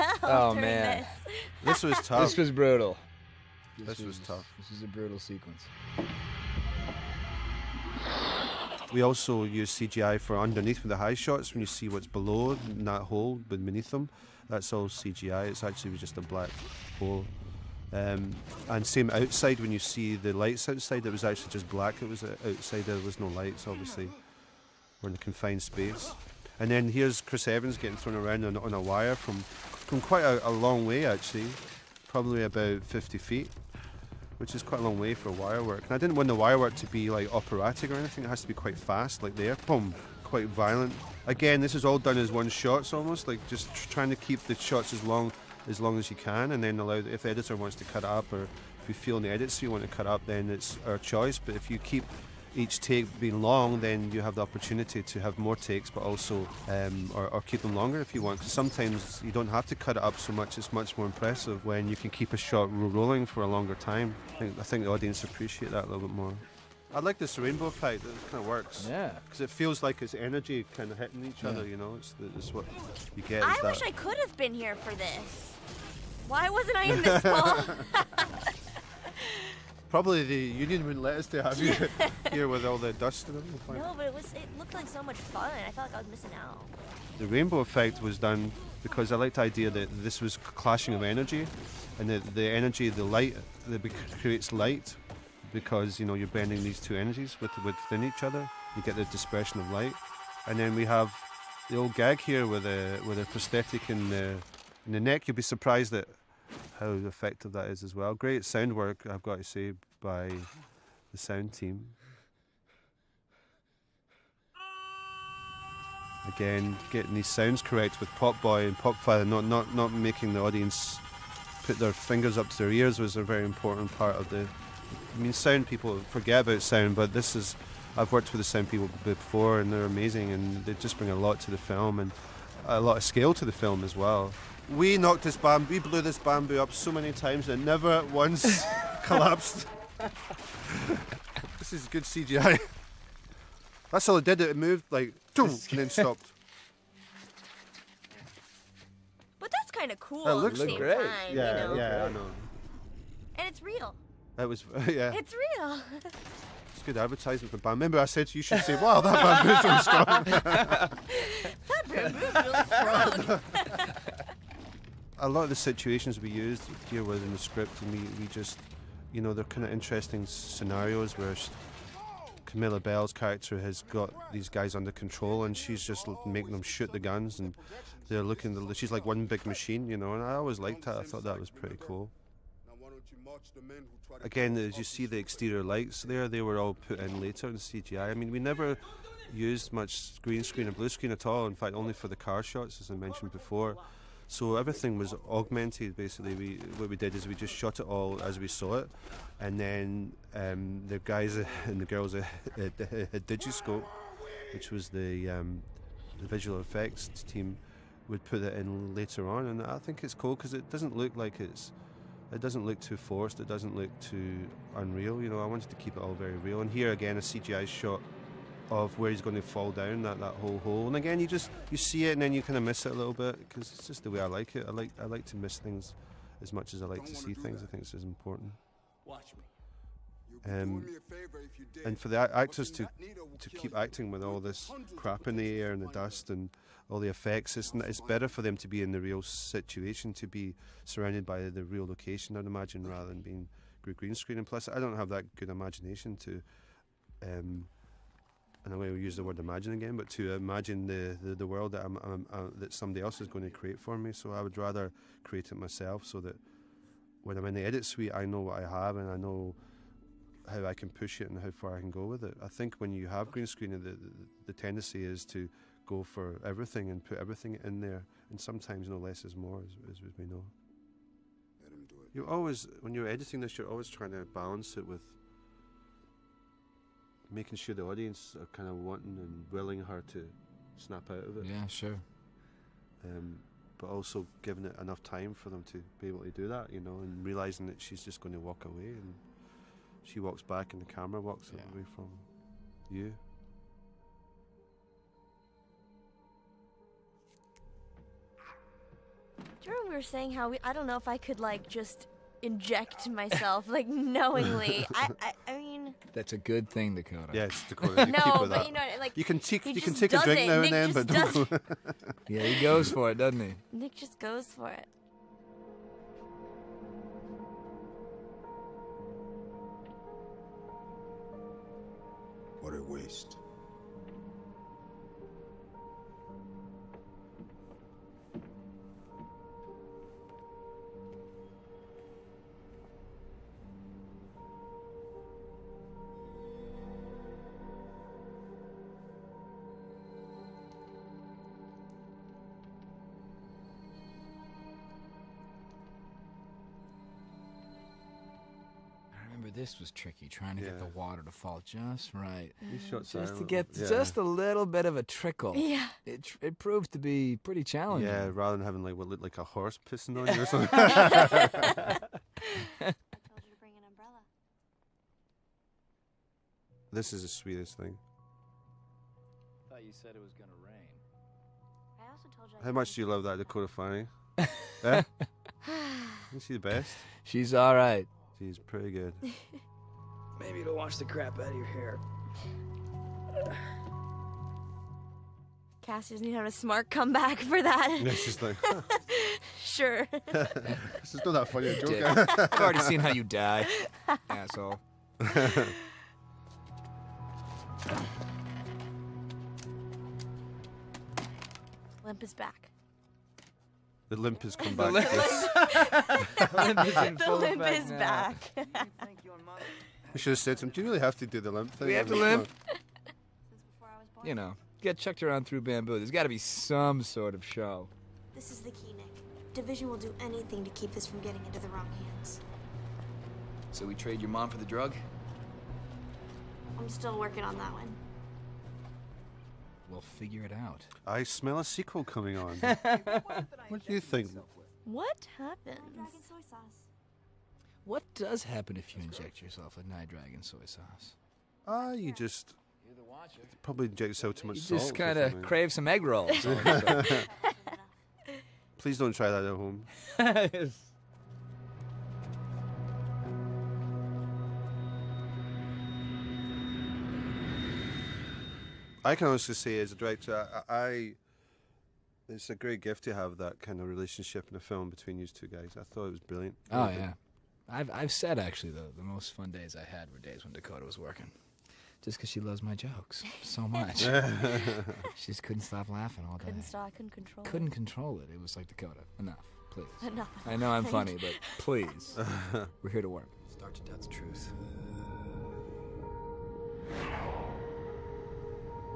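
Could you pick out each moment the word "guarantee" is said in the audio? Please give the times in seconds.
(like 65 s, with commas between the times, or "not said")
not said.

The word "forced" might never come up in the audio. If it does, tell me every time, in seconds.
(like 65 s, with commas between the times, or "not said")
212 s.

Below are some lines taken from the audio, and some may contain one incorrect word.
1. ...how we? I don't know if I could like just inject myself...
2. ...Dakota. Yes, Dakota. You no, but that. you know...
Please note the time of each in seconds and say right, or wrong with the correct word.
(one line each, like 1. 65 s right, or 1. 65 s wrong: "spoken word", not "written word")
1. 300 s right
2. 306 s right.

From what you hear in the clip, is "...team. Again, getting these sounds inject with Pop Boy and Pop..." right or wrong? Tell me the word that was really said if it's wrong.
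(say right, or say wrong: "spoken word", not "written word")
wrong: "correct", not "inject".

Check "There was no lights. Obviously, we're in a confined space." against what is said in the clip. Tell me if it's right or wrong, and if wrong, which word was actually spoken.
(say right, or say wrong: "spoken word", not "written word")
right.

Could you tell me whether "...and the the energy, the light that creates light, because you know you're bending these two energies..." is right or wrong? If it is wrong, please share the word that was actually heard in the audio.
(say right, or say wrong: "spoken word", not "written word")
right.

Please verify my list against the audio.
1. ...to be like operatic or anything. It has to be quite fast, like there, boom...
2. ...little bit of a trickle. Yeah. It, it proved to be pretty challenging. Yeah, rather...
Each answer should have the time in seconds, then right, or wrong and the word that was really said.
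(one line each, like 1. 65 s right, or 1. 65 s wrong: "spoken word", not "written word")
1. 36 s right
2. 354 s right.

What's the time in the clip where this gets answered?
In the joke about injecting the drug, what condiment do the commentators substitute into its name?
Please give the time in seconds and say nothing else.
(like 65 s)
440 s.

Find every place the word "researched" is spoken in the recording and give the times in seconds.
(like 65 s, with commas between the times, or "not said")
not said.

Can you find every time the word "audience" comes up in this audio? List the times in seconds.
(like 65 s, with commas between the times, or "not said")
64 s, 120 s, 277 s.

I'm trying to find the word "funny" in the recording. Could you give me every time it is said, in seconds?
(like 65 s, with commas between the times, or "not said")
391 s, 480 s.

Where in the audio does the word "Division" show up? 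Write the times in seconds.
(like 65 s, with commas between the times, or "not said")
419 s.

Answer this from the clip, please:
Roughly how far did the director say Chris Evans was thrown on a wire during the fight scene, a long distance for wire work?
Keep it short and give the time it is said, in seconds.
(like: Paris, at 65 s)
50 feet, at 32 s.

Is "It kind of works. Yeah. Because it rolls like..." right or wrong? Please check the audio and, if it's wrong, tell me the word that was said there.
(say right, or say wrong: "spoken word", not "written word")
wrong: "feels", not "rolls".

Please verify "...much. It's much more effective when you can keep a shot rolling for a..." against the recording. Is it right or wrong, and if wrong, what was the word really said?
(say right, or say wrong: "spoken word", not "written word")
wrong: "impressive", not "effective".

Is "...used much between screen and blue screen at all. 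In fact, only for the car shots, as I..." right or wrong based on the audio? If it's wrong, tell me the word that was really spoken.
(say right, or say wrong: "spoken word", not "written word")
wrong: "green", not "between".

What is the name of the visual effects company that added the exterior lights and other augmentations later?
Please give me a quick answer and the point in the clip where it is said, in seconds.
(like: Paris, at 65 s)
Digiscope, at 203 s.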